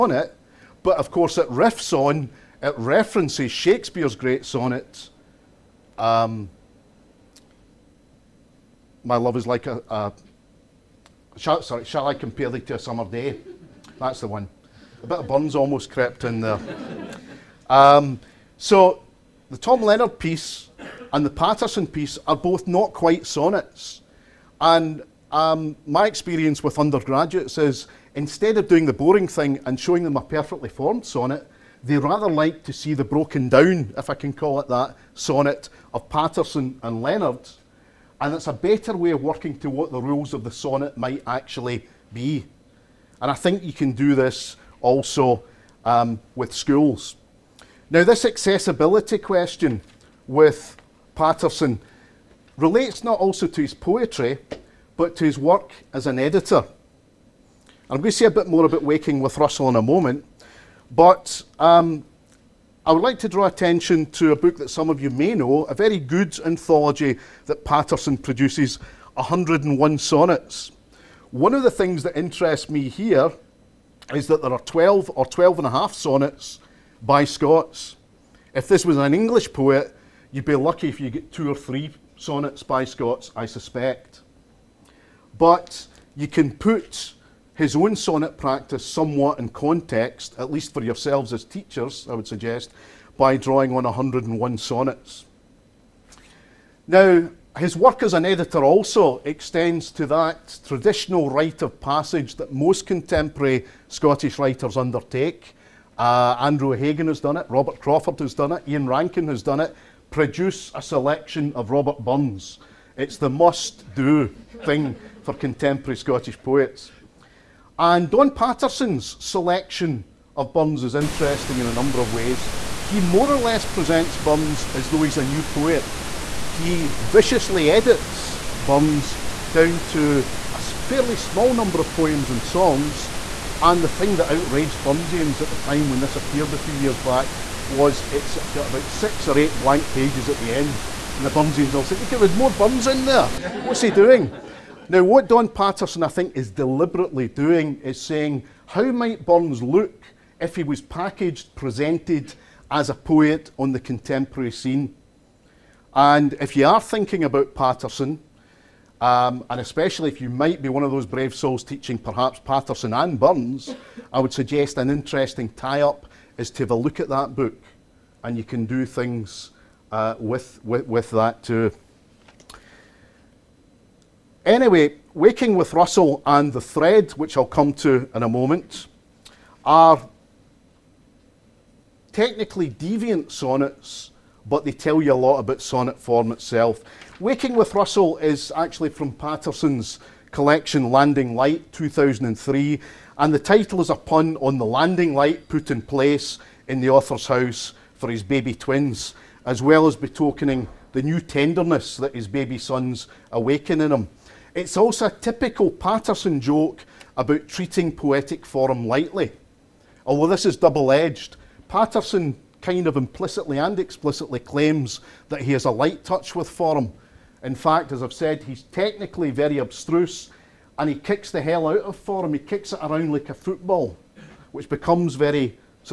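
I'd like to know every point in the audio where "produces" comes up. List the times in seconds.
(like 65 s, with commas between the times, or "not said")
68 s, 110 s.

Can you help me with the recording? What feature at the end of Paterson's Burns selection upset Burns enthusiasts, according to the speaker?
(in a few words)
Six or eight blank pages.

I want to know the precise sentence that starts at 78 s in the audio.
If this was an English poet, You'd be lucky if you get two or three sonnets by Scots, I suspect.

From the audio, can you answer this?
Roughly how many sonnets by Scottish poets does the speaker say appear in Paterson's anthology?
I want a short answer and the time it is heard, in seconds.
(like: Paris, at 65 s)
12 or 12 and a half, at 74 s.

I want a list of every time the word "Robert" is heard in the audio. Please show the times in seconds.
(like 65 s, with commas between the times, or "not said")
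107 s, 111 s.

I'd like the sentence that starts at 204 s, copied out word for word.
It's also a typical Paterson joke about treating poetic form lightly.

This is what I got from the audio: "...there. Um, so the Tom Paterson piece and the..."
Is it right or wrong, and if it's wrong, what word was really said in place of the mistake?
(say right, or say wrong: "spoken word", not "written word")
wrong: "Leonard", not "Paterson".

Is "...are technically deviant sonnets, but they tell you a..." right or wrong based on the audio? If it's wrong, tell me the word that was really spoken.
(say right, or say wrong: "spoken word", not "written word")
right.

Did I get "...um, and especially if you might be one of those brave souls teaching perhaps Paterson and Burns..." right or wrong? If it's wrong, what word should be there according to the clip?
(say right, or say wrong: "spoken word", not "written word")
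right.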